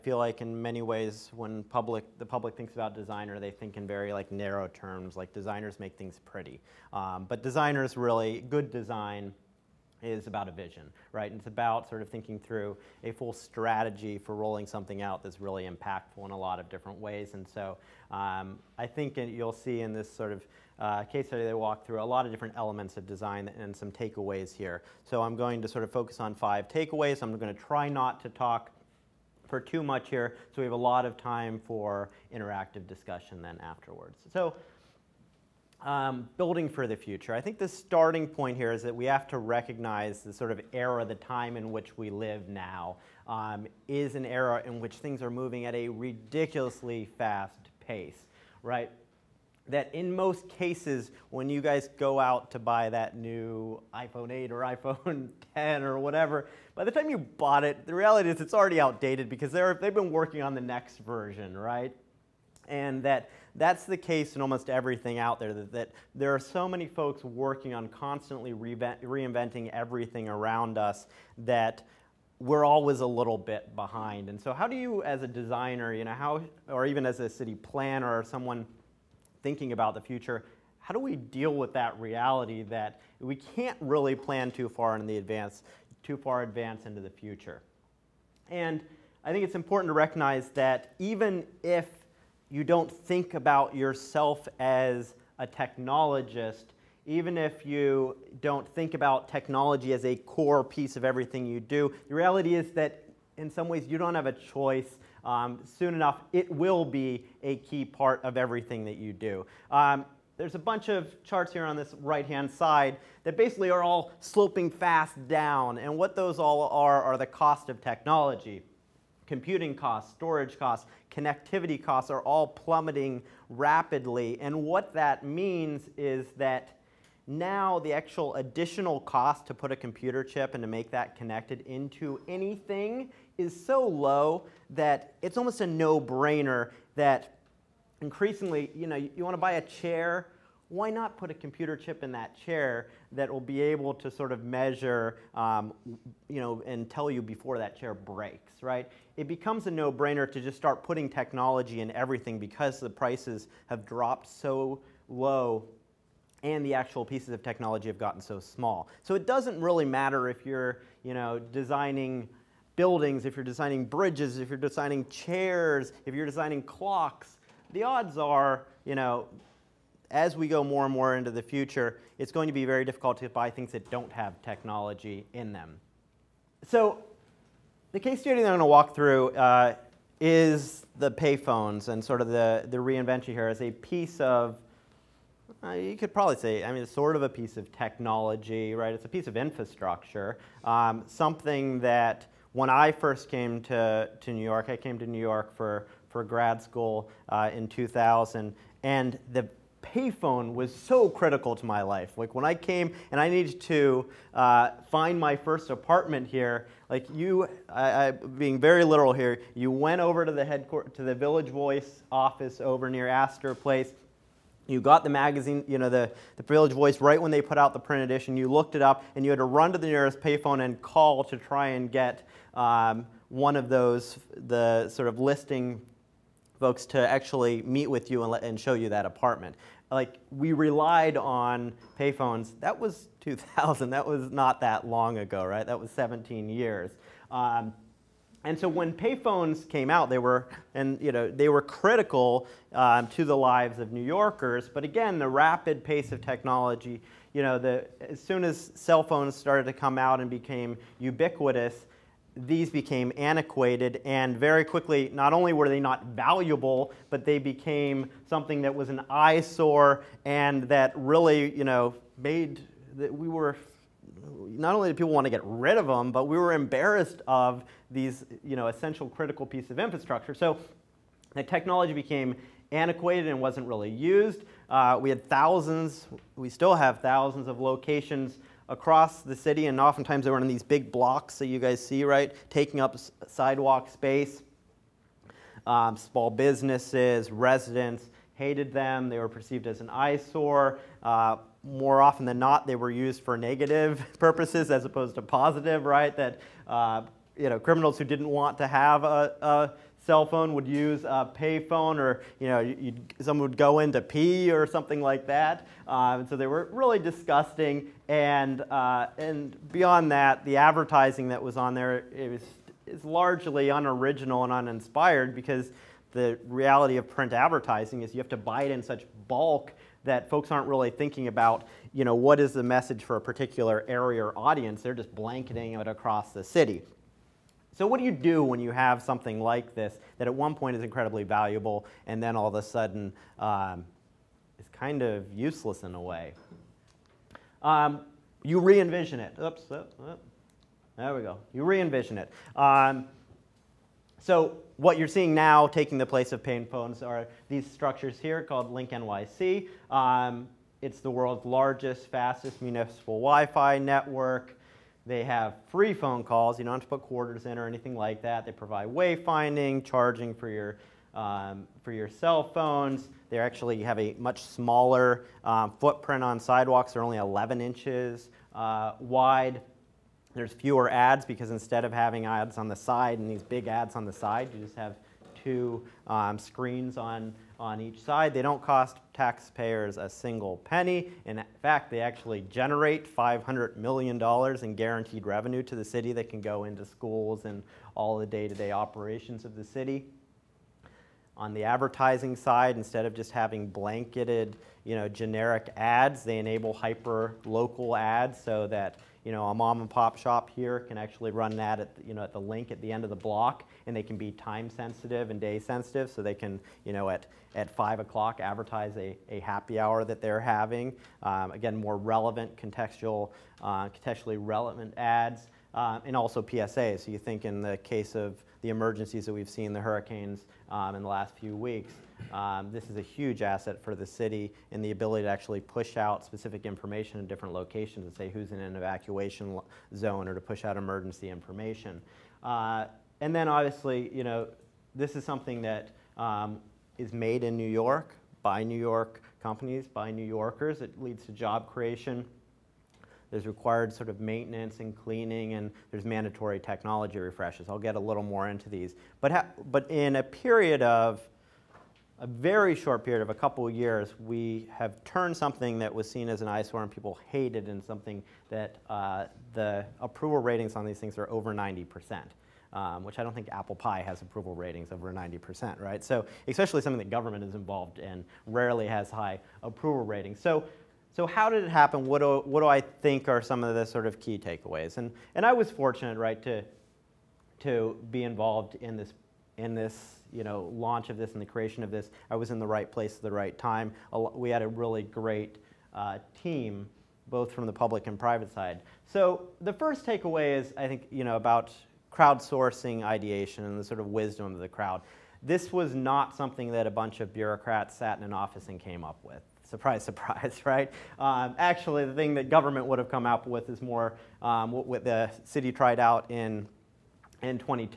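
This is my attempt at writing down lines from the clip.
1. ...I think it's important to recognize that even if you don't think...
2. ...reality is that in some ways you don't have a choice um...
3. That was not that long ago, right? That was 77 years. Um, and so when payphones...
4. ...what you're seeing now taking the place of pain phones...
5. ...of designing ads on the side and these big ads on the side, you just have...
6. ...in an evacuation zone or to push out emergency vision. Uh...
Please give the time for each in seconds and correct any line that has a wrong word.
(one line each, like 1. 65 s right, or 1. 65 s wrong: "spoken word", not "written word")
1. 89 s right
2. 102 s right
3. 233 s wrong: "17", not "77"
4. 344 s right
5. 371 s wrong: "having", not "designing"
6. 428 s wrong: "information", not "vision".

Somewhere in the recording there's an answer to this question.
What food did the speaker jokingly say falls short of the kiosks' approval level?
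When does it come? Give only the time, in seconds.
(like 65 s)
463 s.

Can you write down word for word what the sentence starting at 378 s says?
They don't cost taxpayers a single penny.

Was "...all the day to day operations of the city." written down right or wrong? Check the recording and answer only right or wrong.
right.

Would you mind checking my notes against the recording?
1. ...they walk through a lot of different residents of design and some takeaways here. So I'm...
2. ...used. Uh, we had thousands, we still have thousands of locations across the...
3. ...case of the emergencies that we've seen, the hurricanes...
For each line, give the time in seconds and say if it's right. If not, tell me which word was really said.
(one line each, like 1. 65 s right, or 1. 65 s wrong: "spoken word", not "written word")
1. 21 s wrong: "elements", not "residents"
2. 273 s right
3. 417 s right.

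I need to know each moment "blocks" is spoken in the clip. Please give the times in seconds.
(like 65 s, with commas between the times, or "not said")
280 s, 403 s.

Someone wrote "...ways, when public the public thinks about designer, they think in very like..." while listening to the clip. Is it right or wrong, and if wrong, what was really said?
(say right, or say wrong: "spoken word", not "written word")
right.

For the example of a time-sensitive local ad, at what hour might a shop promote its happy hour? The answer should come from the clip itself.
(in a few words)
5 o'clock.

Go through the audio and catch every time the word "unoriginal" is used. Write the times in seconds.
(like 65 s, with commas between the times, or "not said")
313 s.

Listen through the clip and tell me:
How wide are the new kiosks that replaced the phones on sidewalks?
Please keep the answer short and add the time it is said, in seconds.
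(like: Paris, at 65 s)
11 inches, at 367 s.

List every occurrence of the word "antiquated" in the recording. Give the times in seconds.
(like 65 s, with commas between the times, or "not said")
253 s, 272 s.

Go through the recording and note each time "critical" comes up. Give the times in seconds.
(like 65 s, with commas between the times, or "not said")
201 s, 241 s, 269 s.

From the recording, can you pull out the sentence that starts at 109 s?
Um, there's a bunch of charts here on this right hand side that basically are all sloping fast down.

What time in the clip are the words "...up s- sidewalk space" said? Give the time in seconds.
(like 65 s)
282 s.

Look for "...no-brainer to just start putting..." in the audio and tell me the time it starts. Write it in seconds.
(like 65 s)
149 s.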